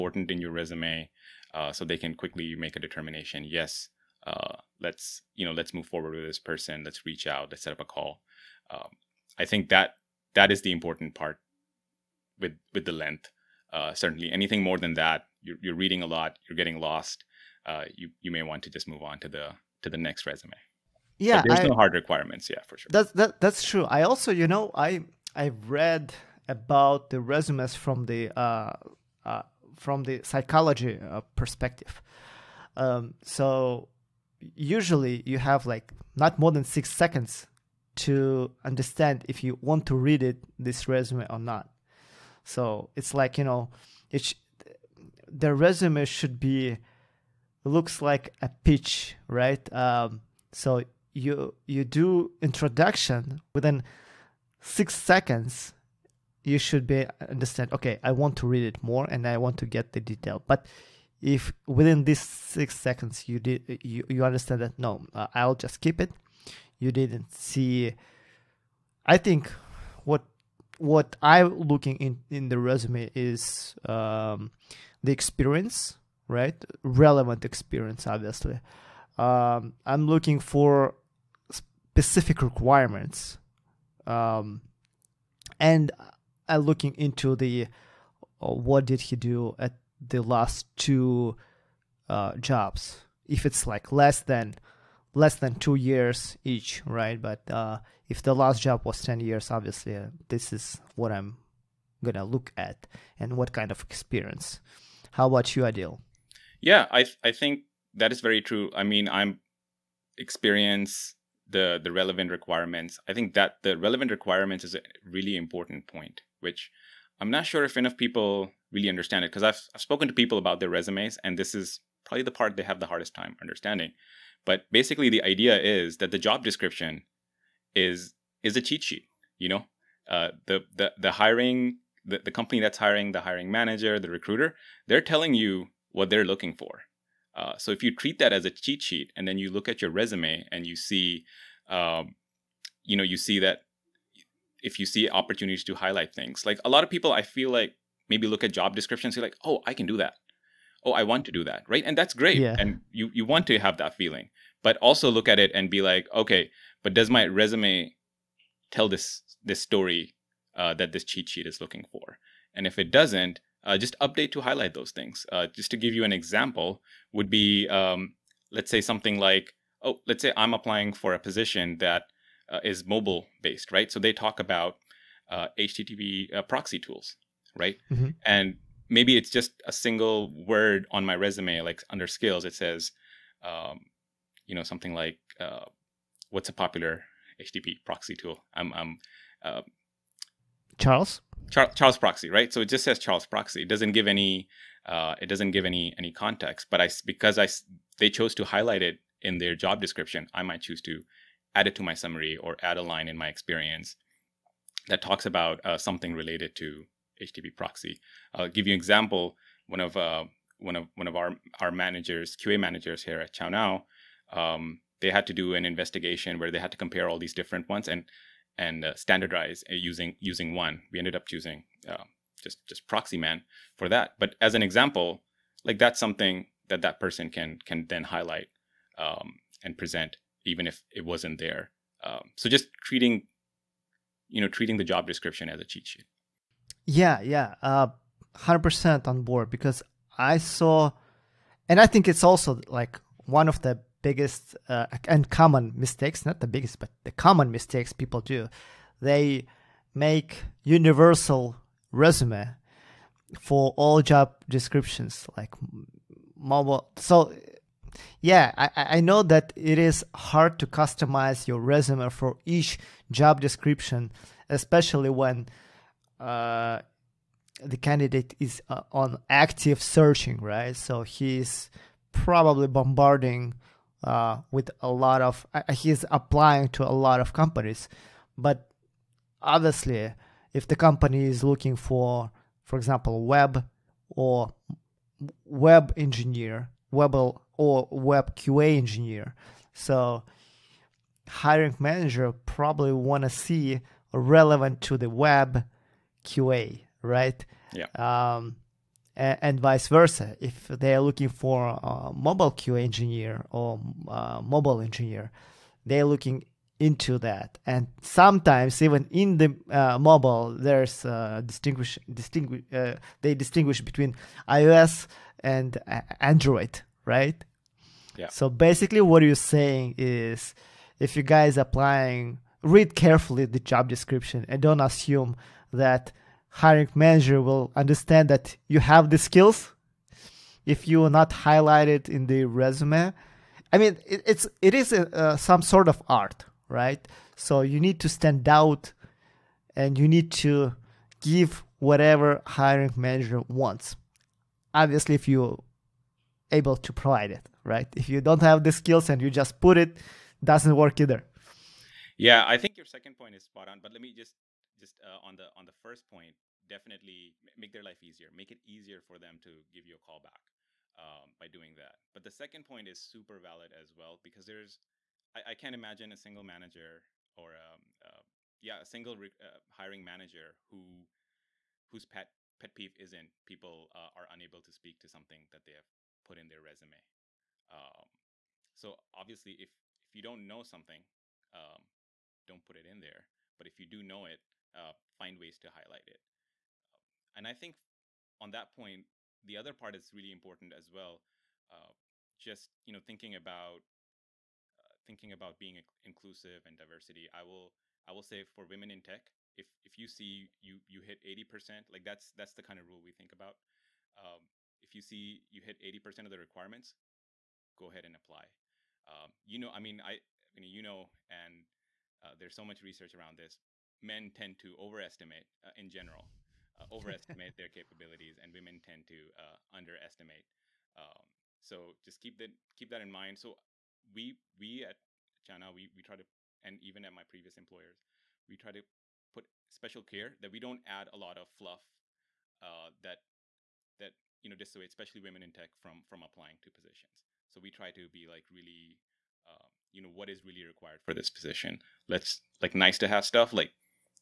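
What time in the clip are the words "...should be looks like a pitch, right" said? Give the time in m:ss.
0:46.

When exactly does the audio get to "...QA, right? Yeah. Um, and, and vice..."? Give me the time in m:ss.
4:56.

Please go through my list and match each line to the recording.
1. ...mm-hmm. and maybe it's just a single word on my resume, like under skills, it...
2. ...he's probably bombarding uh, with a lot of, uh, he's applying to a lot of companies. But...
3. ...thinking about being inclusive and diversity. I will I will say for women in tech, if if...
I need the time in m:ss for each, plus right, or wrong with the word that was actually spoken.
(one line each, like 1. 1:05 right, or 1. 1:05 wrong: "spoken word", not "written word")
1. 2:57 right
2. 4:31 right
3. 6:35 right.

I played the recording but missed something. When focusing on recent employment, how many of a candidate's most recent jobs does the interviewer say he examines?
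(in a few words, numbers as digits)
2.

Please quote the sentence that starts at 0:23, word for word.
I also, you know, I I read about the resumes from the uh, uh from the psychology uh, perspective.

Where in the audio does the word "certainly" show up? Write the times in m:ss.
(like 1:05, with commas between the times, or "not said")
0:13.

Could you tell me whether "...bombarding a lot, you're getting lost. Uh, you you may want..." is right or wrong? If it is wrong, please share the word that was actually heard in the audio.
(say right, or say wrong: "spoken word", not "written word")
wrong: "reading", not "bombarding".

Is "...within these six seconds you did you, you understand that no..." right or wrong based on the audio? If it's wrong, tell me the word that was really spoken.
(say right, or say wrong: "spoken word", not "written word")
right.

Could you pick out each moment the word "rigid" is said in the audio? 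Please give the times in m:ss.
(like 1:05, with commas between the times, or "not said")
not said.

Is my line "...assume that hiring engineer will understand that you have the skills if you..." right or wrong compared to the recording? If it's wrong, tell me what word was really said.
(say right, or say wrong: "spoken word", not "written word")
wrong: "manager", not "engineer".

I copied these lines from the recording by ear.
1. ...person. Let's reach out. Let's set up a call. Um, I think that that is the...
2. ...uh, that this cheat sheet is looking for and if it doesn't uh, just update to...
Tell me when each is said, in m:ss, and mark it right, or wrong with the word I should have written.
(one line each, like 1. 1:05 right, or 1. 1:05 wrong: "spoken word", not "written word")
1. 0:06 right
2. 2:40 right.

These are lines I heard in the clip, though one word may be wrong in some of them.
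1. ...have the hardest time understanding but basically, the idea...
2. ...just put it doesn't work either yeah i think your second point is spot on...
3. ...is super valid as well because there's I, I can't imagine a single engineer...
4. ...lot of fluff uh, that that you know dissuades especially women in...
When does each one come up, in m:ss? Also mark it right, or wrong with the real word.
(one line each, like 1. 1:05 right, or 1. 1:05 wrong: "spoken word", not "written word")
1. 2:02 right
2. 5:49 right
3. 6:02 wrong: "manager", not "engineer"
4. 7:11 right.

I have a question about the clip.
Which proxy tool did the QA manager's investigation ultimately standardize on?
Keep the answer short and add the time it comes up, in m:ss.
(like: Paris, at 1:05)
Proxyman, at 3:42.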